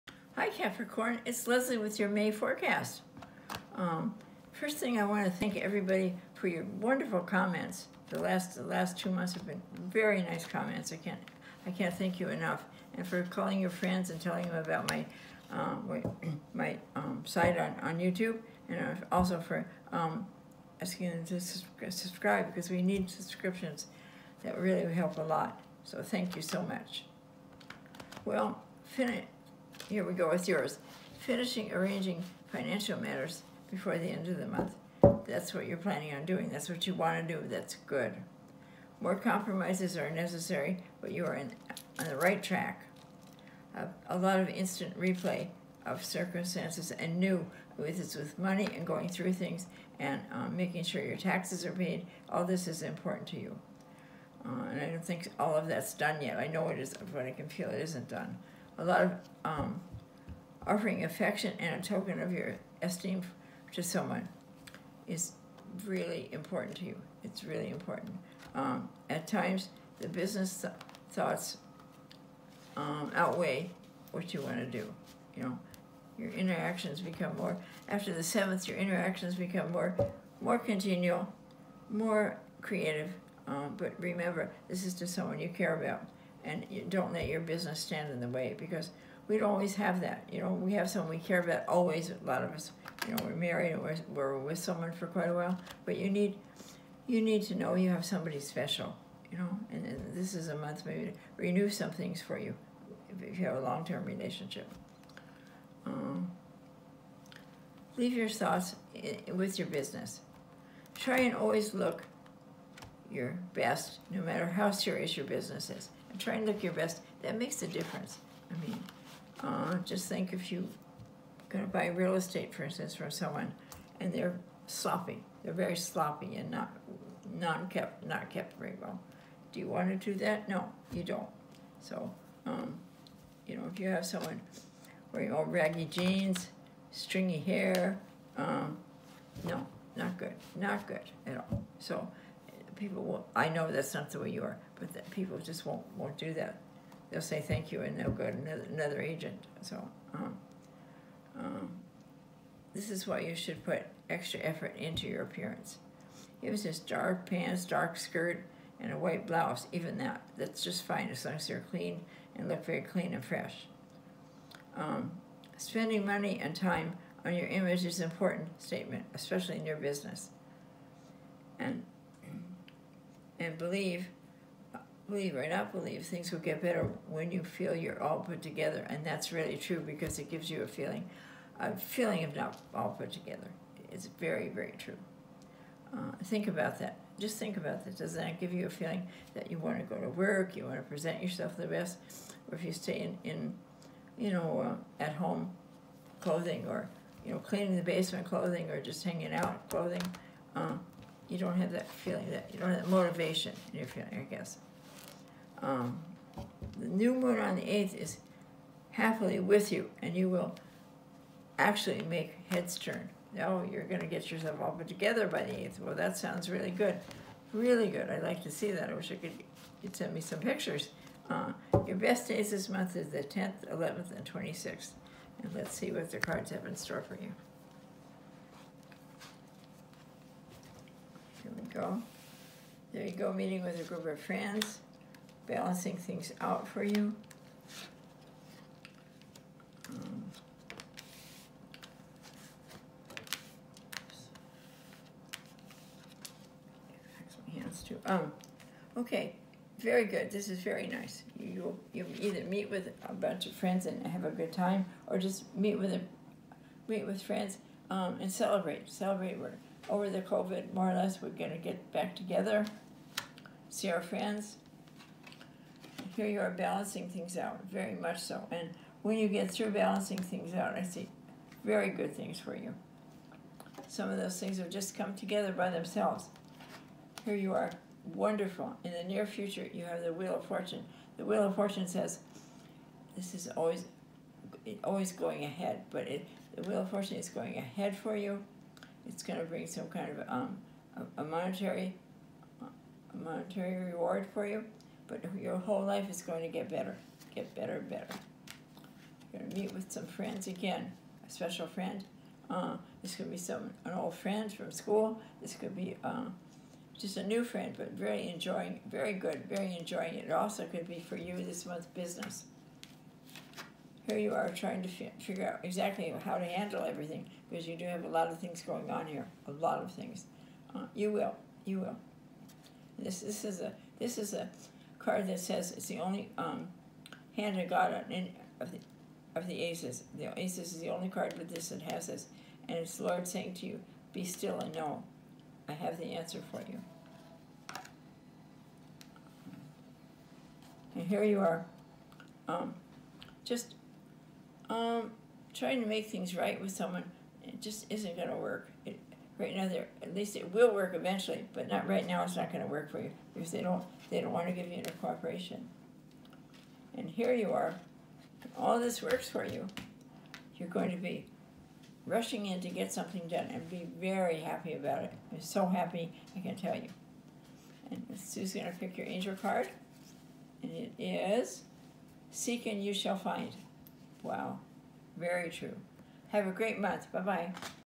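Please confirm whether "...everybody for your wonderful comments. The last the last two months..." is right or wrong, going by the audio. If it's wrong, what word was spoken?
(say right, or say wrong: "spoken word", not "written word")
right.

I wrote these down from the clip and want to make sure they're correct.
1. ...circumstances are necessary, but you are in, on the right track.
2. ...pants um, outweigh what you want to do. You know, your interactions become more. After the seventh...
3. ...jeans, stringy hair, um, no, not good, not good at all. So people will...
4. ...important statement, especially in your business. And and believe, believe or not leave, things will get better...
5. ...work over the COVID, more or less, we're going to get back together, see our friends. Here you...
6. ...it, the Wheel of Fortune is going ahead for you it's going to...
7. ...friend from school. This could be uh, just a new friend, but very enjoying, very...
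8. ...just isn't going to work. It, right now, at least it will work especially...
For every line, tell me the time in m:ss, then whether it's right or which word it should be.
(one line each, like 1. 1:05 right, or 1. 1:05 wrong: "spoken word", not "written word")
1. 0:39 wrong: "compromises", not "circumstances"
2. 1:11 wrong: "thoughts", not "pants"
3. 2:15 right
4. 2:48 wrong: "believe", not "leave"
5. 4:19 right
6. 4:46 right
7. 5:04 right
8. 5:47 wrong: "eventually", not "especially".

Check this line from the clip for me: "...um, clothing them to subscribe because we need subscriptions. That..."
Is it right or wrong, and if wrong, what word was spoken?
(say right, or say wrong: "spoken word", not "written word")
wrong: "asking", not "clothing".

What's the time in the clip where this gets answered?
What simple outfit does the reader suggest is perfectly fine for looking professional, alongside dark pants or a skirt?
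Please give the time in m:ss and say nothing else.
2:38.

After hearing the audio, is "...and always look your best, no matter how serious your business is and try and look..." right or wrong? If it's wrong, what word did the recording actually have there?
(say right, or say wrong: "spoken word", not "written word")
right.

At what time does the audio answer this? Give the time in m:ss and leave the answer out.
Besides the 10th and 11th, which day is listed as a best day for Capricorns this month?
3:44.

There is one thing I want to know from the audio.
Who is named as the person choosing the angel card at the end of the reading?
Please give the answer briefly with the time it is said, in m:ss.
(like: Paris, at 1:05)
Sue, at 6:08.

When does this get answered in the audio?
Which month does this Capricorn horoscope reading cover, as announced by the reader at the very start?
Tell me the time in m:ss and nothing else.
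0:02.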